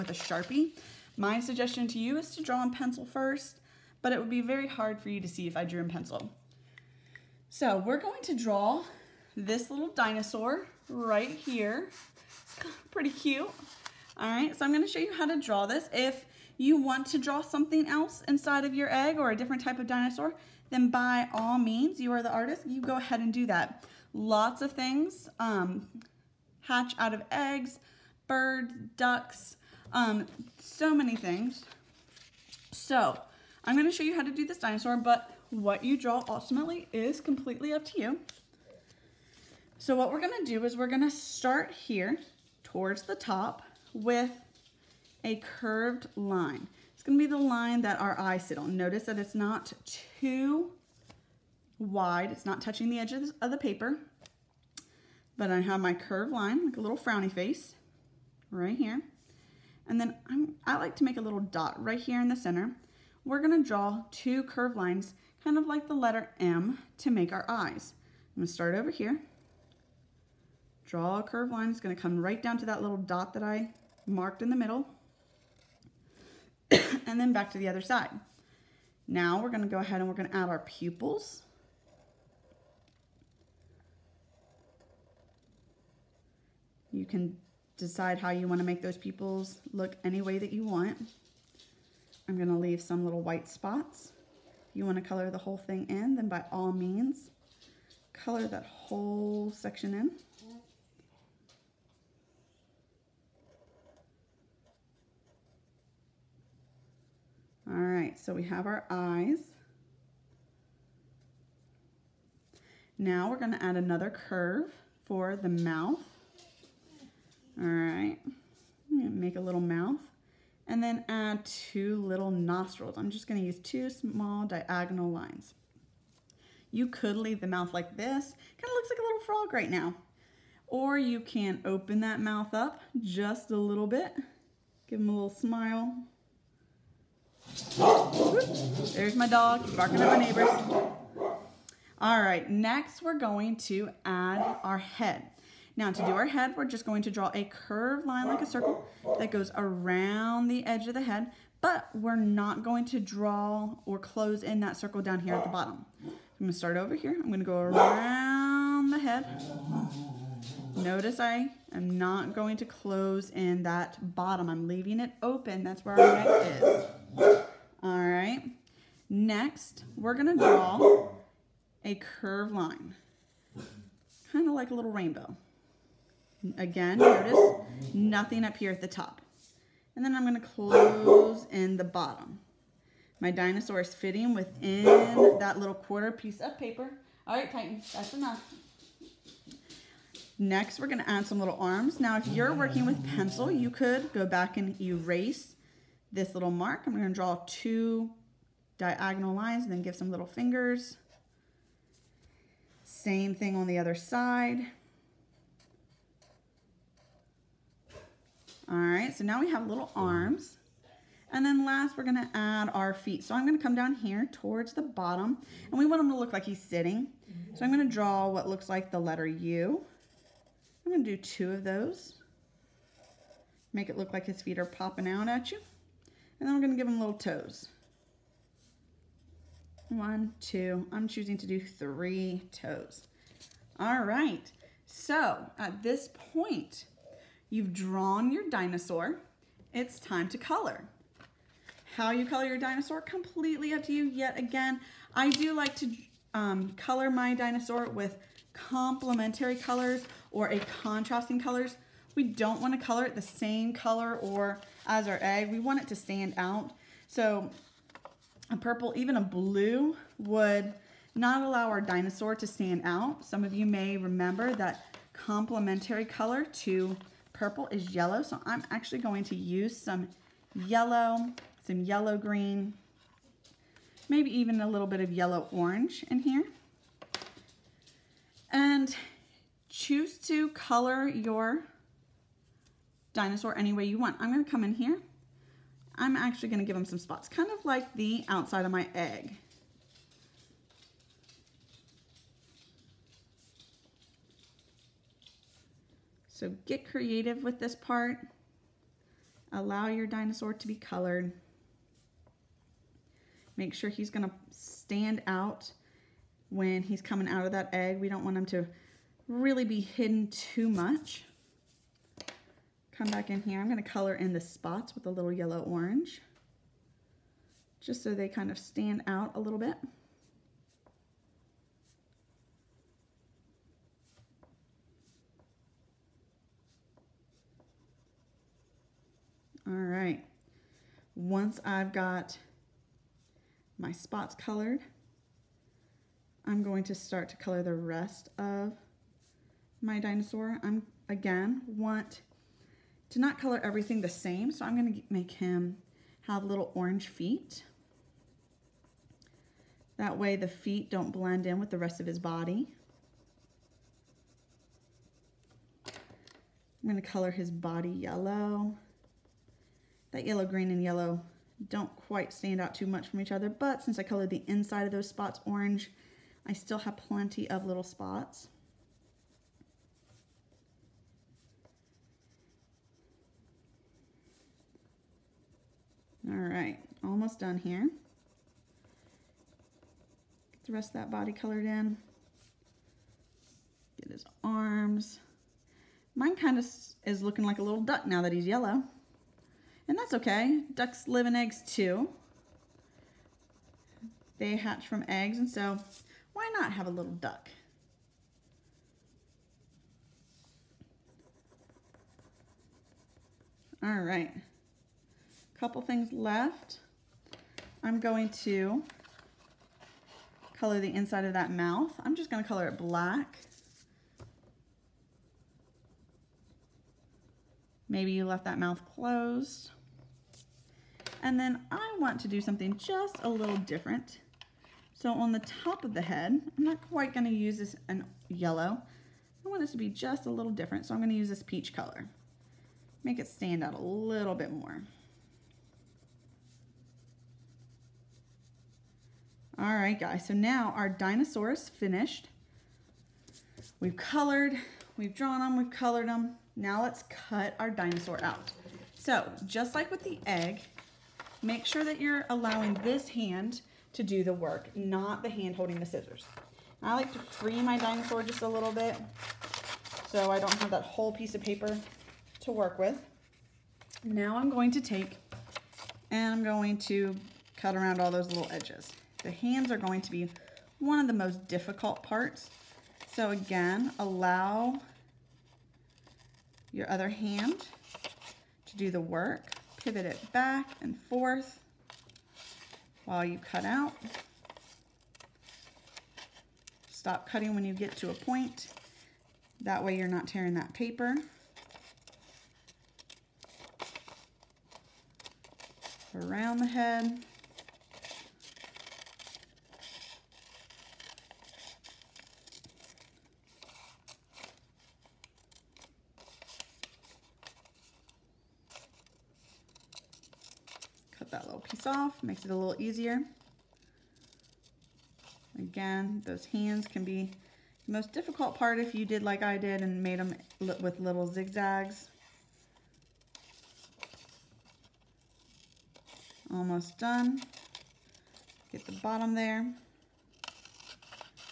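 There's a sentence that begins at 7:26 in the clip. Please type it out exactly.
Now let's cut our dinosaur out.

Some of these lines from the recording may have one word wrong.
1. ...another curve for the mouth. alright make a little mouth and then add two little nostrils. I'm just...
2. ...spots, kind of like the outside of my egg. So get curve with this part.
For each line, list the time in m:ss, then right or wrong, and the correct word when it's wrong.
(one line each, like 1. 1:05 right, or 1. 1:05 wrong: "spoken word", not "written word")
1. 1:53 right
2. 4:46 wrong: "creative", not "curve".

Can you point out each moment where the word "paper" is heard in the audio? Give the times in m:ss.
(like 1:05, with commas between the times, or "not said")
0:53, 3:06, 7:41, 8:10.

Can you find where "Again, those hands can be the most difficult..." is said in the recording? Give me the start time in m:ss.
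8:35.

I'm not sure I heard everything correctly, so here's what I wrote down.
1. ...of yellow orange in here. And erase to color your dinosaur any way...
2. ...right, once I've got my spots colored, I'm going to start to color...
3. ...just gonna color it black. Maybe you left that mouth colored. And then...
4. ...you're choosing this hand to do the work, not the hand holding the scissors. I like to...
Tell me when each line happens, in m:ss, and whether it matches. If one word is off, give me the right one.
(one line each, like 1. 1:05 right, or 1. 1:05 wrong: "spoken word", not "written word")
1. 4:34 wrong: "choose", not "erase"
2. 5:29 right
3. 6:52 wrong: "closed", not "colored"
4. 7:31 wrong: "allowing", not "choosing".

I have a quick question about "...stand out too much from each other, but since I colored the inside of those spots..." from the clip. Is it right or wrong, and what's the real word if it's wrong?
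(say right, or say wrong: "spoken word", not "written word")
right.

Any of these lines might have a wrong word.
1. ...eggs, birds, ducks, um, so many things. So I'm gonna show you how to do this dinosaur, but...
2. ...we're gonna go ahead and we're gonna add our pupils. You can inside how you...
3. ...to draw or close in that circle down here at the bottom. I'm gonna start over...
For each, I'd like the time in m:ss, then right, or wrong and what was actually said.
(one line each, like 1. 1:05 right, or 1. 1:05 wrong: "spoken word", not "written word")
1. 0:27 right
2. 1:19 wrong: "decide", not "inside"
3. 2:32 right.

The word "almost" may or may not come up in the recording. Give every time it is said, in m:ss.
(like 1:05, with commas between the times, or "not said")
6:17, 8:46.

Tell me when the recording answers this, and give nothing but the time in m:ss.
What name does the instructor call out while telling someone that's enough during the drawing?
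3:07.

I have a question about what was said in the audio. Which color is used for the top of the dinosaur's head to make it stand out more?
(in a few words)
peach.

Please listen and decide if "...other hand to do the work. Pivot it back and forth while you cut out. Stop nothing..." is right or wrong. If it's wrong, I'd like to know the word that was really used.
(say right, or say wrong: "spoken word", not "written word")
wrong: "cutting", not "nothing".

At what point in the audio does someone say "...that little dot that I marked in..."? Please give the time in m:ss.
1:12.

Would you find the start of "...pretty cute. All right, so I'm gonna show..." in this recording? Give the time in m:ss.
0:12.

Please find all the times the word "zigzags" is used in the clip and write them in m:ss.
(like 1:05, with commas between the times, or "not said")
8:41.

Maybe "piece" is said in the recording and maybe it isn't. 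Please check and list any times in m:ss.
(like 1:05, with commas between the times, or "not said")
3:06, 7:41.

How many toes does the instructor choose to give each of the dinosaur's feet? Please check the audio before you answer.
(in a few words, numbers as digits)
3.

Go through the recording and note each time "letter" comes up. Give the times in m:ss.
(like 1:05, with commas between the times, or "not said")
1:05, 3:38.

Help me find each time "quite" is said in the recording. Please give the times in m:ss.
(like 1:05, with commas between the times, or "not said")
6:01, 7:06.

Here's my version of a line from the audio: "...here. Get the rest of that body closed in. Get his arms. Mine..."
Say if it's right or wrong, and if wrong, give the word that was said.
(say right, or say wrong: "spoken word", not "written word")
wrong: "colored", not "closed".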